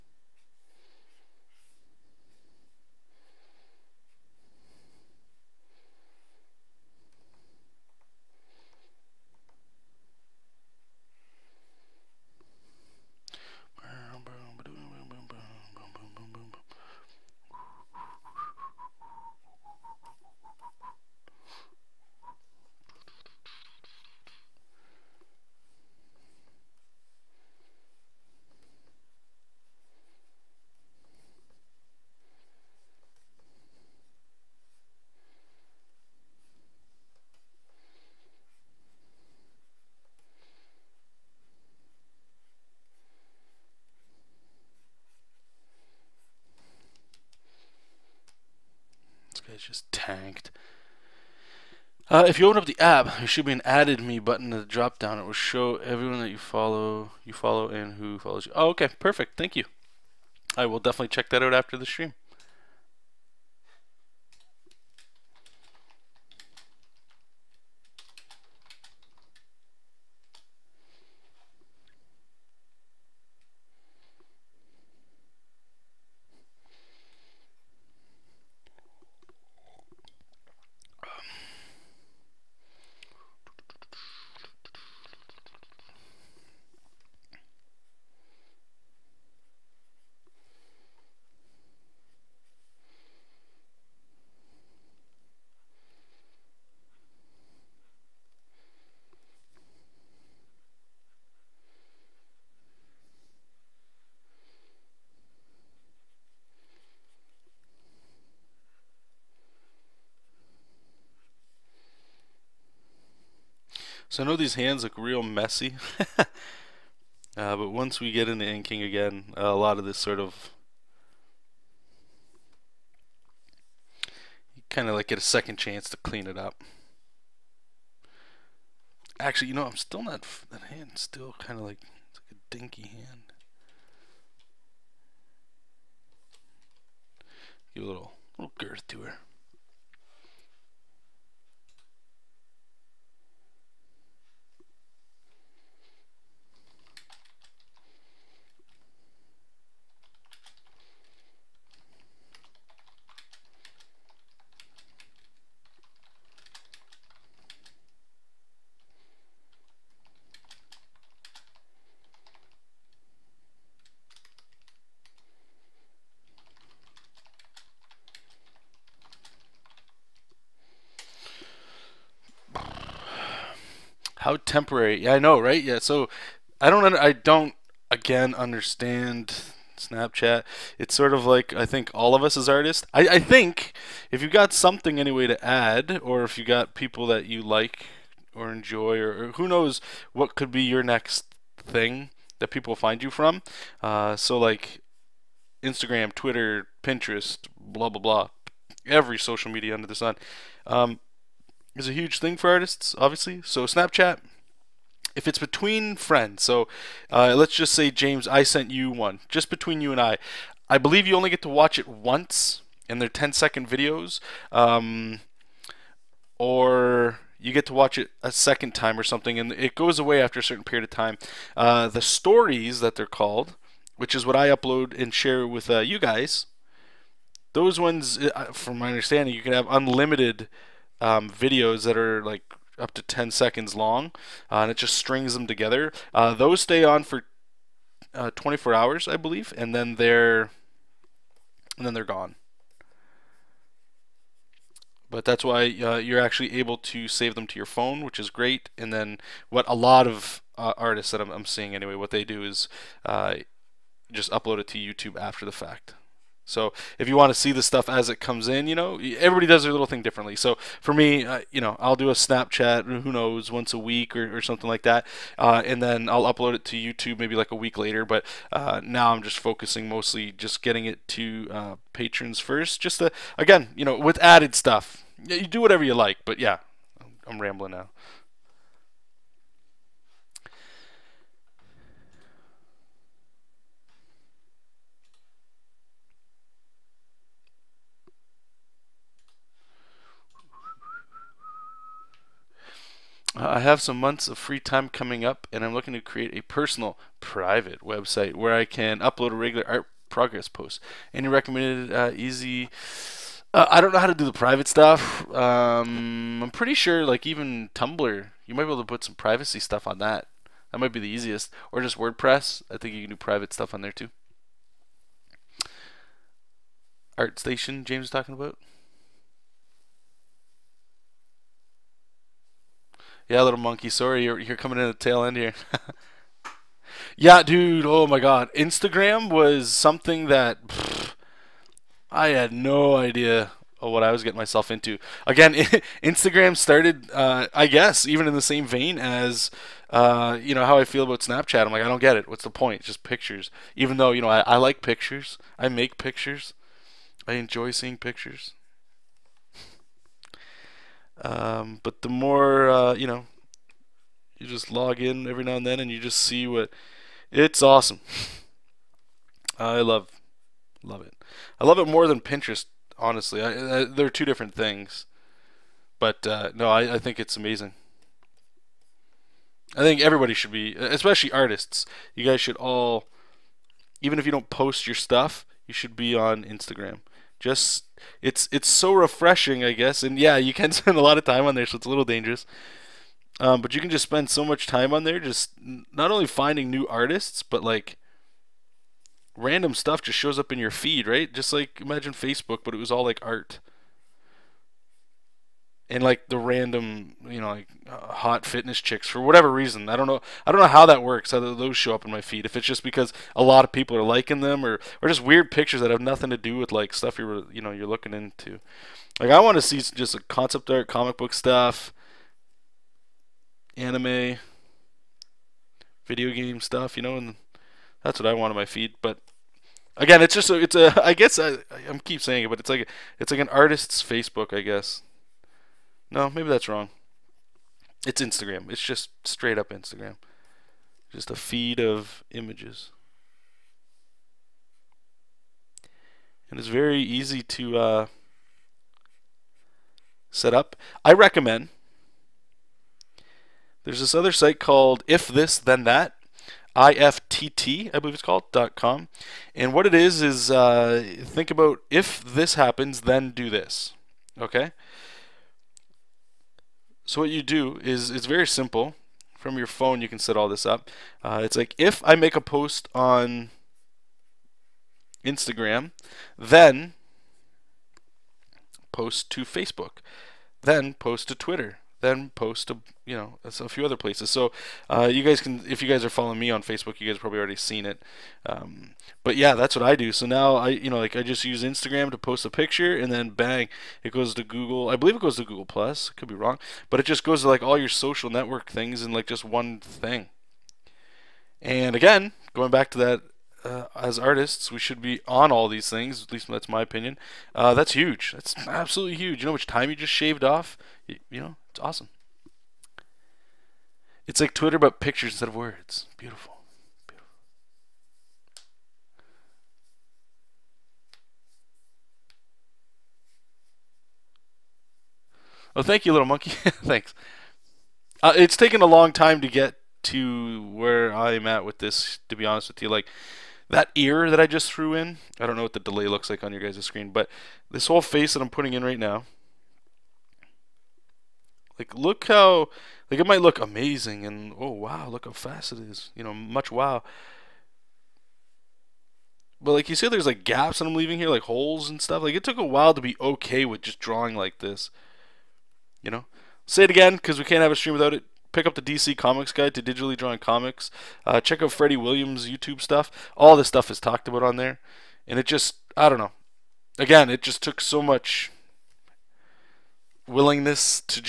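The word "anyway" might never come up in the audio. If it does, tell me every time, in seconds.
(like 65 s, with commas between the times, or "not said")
184 s, 251 s.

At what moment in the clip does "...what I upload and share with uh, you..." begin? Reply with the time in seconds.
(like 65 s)
224 s.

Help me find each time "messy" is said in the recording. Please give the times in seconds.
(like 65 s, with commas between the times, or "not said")
115 s.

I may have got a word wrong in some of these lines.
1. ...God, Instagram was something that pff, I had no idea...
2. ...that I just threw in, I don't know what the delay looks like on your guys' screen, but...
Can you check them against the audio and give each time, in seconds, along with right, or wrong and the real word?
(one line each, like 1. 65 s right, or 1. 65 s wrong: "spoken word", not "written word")
1. 328 s right
2. 524 s right.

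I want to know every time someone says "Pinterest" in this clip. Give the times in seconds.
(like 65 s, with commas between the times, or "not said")
196 s, 362 s.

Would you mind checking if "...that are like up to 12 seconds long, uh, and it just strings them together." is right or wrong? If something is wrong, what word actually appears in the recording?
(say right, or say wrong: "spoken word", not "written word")
wrong: "10", not "12".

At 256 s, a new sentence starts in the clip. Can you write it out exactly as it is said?
So if you want to see the stuff as it comes in, you know, everybody does their little thing differently.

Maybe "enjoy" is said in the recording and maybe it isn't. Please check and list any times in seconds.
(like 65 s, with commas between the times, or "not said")
188 s, 347 s.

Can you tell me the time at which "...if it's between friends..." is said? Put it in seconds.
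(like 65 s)
205 s.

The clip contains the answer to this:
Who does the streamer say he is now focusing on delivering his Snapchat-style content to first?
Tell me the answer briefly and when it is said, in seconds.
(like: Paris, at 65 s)
Patrons, at 271 s.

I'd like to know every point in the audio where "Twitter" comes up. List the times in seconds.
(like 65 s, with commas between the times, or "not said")
196 s, 471 s, 504 s.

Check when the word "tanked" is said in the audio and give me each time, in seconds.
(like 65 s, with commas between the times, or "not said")
50 s.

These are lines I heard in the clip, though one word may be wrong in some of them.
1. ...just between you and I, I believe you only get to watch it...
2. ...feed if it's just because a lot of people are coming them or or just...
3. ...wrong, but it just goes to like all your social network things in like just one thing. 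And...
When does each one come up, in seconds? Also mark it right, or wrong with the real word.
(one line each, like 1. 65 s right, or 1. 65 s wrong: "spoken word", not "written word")
1. 209 s right
2. 402 s wrong: "liking", not "coming"
3. 486 s right.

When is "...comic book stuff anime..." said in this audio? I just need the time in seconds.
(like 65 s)
410 s.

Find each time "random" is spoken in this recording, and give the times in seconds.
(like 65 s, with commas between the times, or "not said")
389 s, 396 s.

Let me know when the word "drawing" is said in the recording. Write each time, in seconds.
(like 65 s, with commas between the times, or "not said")
543 s, 550 s.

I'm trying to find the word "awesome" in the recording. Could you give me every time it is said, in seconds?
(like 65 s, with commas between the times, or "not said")
357 s, 501 s.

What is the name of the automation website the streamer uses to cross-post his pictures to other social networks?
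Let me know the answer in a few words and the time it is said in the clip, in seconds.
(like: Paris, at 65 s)
If This Then That, at 445 s.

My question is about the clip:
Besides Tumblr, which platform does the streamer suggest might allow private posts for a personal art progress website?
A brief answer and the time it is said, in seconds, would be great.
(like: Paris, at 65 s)
WordPress, at 311 s.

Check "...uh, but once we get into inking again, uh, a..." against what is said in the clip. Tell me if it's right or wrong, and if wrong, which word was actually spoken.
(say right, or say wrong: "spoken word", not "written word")
right.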